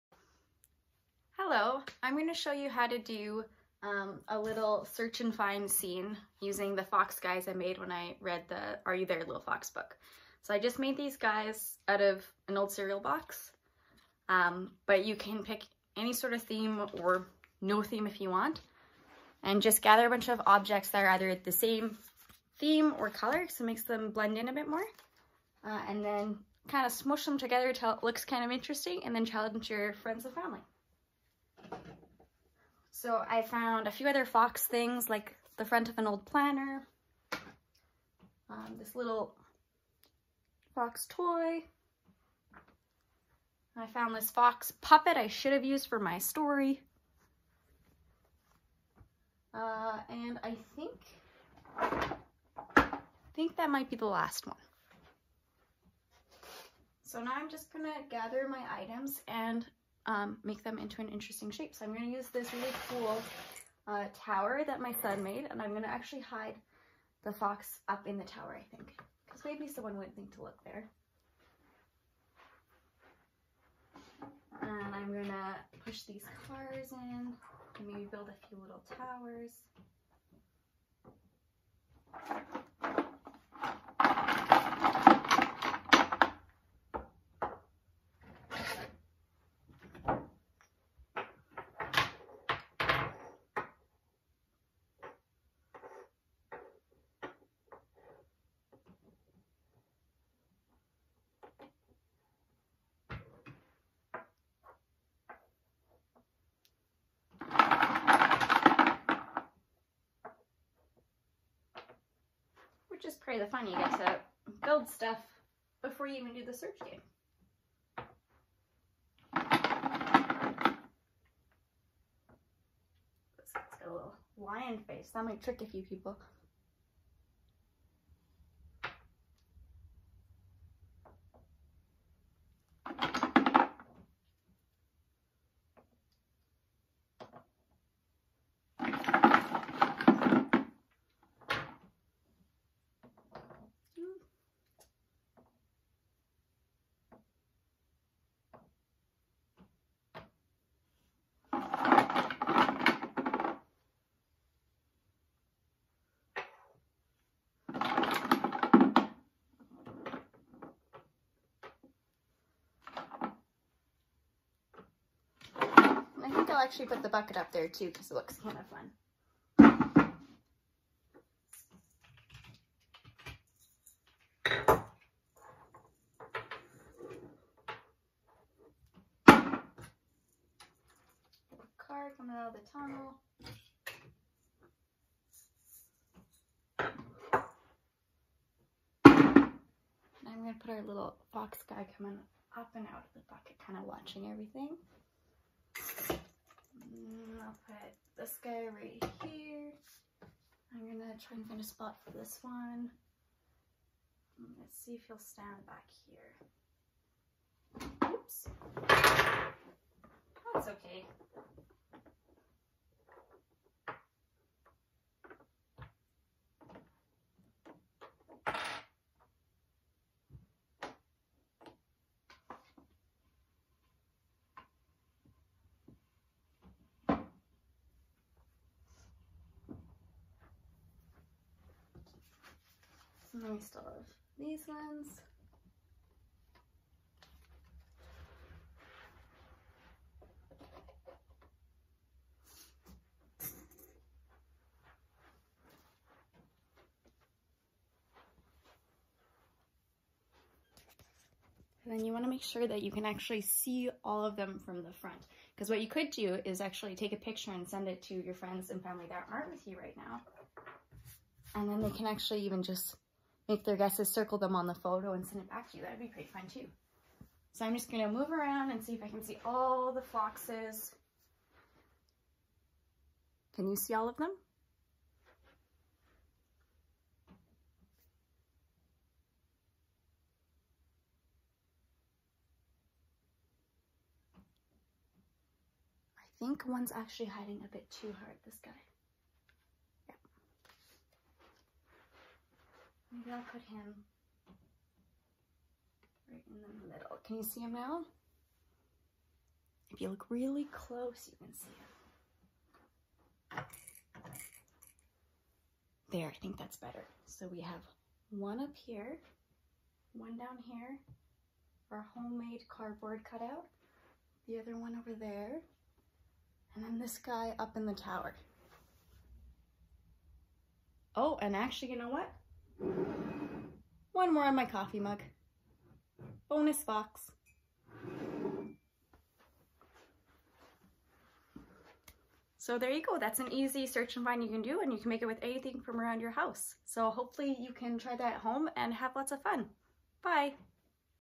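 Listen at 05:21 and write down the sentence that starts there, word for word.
Oh, and actually, you know what?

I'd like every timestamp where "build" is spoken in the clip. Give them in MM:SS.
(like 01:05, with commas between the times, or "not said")
01:18, 01:54.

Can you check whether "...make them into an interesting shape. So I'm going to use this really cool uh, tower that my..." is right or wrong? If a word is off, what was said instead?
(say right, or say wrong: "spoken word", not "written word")
right.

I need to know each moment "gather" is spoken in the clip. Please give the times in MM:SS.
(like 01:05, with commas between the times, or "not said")
00:19, 00:58.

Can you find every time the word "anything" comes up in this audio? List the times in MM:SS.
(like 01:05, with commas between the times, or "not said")
05:35.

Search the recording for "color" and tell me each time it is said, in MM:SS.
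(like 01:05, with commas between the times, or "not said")
00:23.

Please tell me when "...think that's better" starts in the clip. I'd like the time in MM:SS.
05:06.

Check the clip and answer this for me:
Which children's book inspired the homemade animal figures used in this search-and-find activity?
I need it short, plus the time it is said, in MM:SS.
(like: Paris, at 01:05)
Are You There Little Fox, at 00:08.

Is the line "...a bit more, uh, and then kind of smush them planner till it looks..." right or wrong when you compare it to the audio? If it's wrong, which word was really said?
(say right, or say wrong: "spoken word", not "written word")
wrong: "together", not "planner".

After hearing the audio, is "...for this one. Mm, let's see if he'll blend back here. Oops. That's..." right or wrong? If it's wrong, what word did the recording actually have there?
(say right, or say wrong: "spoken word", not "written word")
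wrong: "stand", not "blend".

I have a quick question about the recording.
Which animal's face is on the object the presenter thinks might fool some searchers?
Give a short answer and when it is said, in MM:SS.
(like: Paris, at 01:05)
lion, at 02:04.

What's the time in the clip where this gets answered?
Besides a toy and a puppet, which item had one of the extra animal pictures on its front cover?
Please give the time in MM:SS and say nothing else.
00:36.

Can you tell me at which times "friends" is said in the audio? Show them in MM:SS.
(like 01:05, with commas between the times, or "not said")
00:29, 04:18.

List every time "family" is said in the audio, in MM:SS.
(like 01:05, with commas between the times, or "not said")
00:30, 04:18.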